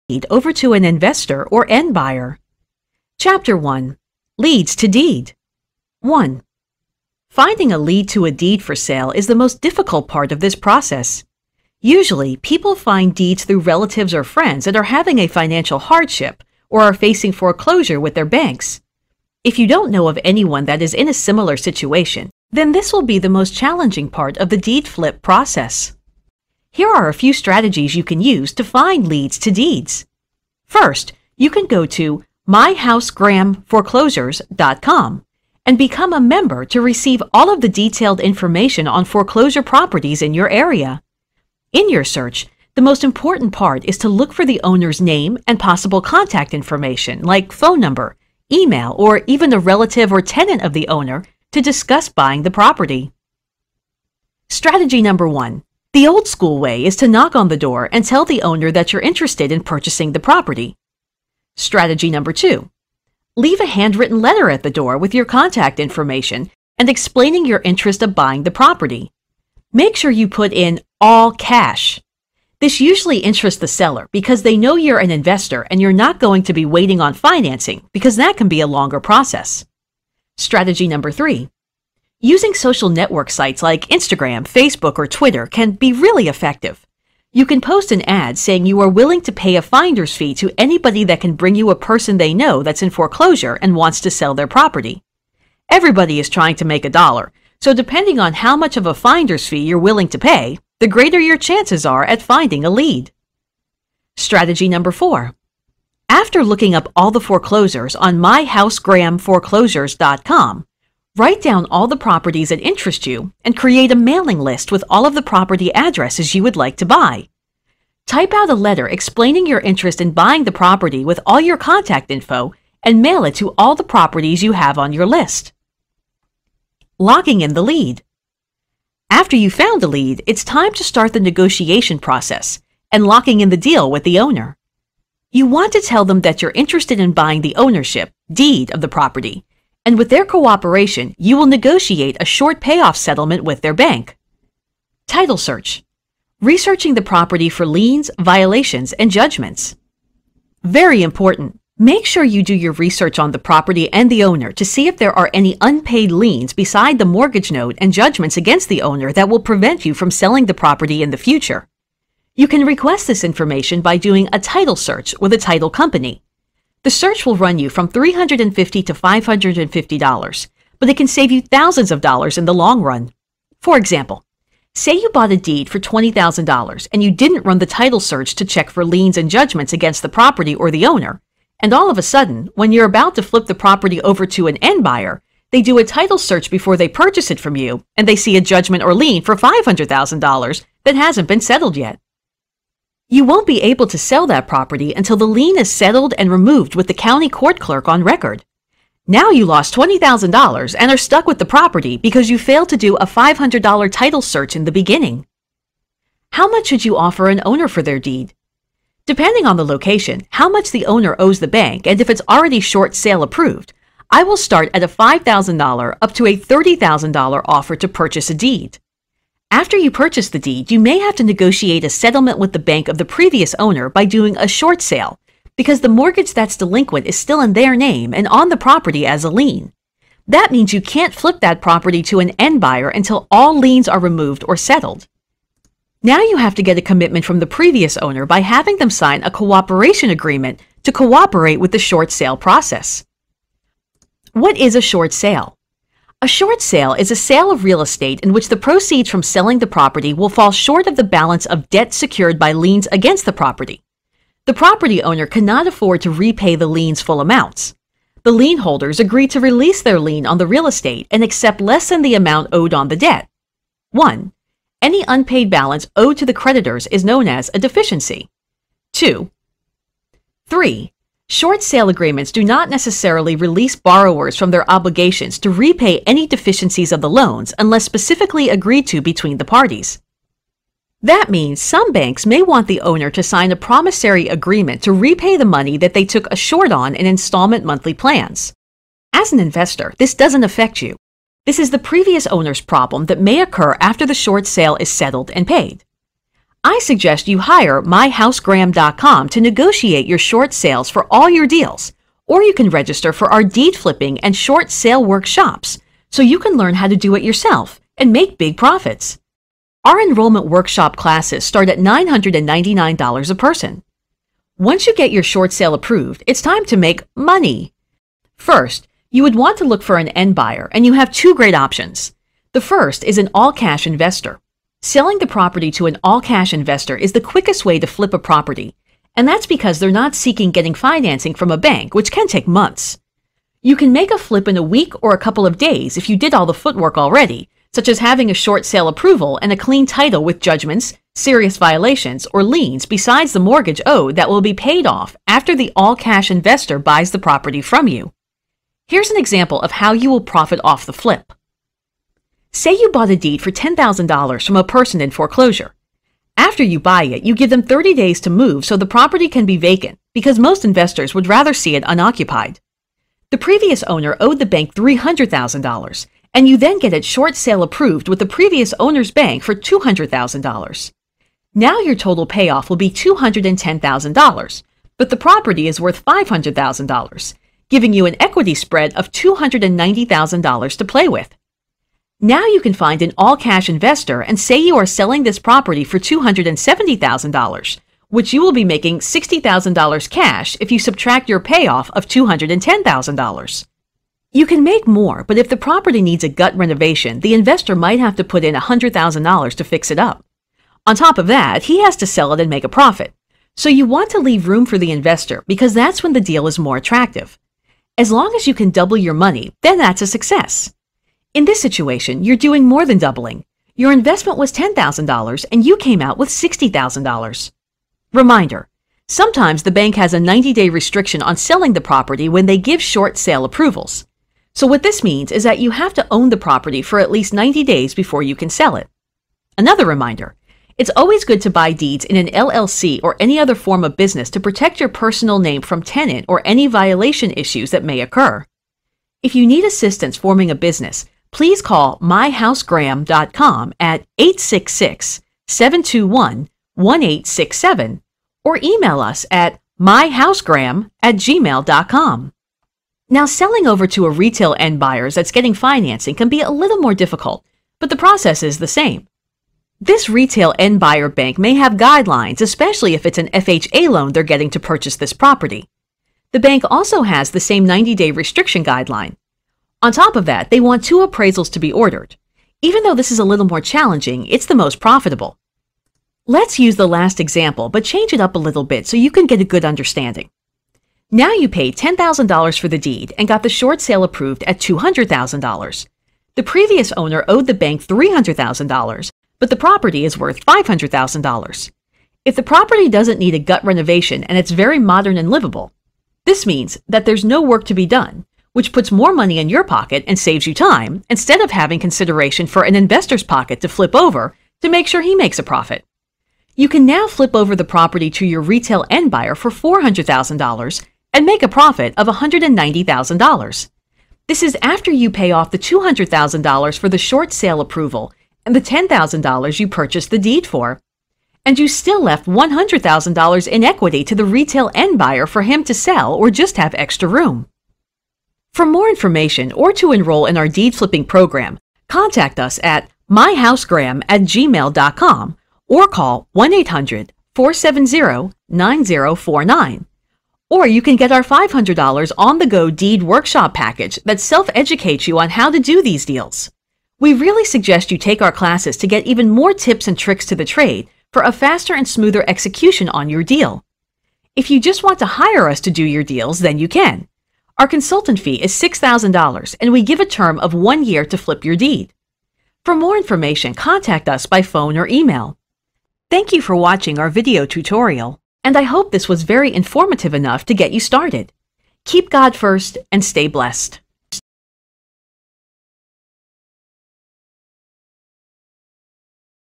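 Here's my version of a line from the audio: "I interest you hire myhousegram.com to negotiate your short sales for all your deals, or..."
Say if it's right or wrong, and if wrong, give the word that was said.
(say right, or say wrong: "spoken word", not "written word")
wrong: "suggest", not "interest".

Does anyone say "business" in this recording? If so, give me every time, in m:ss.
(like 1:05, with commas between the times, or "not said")
7:13, 7:20.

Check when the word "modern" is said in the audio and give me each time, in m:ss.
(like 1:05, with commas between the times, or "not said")
8:14.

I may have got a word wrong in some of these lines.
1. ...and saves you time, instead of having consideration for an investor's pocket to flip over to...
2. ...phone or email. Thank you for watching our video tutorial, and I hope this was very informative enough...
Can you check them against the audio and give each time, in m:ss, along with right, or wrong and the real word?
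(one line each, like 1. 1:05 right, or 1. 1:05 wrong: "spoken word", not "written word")
1. 8:20 right
2. 9:24 right.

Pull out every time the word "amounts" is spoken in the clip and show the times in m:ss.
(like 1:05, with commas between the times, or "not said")
4:17, 4:22.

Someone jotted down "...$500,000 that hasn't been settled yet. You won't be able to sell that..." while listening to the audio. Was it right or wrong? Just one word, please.
right.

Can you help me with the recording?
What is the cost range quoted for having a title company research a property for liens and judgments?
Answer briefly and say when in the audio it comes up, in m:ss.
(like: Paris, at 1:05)
$350 to $550, at 2:47.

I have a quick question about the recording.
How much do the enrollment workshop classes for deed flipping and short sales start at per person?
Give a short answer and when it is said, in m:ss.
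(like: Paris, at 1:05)
$999, at 5:11.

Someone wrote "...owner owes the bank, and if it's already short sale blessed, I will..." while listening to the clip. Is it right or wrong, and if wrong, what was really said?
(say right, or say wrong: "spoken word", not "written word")
wrong: "approved", not "blessed".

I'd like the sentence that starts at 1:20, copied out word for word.
Strategy number three Using social network sites like Instagram, Facebook, or Twitter can be really effective.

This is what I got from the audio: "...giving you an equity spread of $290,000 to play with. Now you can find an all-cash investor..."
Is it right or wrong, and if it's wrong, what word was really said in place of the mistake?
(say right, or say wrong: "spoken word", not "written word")
right.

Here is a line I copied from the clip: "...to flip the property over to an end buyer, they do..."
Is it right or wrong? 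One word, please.
right.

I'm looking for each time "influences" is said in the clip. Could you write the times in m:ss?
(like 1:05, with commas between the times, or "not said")
not said.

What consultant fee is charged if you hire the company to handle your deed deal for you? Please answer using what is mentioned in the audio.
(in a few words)
$6,000.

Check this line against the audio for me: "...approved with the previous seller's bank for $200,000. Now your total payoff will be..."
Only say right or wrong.
wrong.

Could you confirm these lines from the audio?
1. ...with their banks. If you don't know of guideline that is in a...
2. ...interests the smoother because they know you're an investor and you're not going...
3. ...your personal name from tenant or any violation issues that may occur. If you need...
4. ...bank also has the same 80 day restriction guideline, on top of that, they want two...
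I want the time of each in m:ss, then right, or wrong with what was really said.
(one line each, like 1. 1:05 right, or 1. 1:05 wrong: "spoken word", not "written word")
1. 0:18 wrong: "anyone", not "guideline"
2. 1:13 wrong: "seller", not "smoother"
3. 7:14 right
4. 7:46 wrong: "90", not "80".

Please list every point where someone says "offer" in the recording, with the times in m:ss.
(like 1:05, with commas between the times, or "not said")
3:26, 3:37.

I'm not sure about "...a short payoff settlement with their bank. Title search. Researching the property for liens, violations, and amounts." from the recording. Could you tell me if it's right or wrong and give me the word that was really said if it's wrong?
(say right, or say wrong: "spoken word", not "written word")
wrong: "judgments", not "amounts".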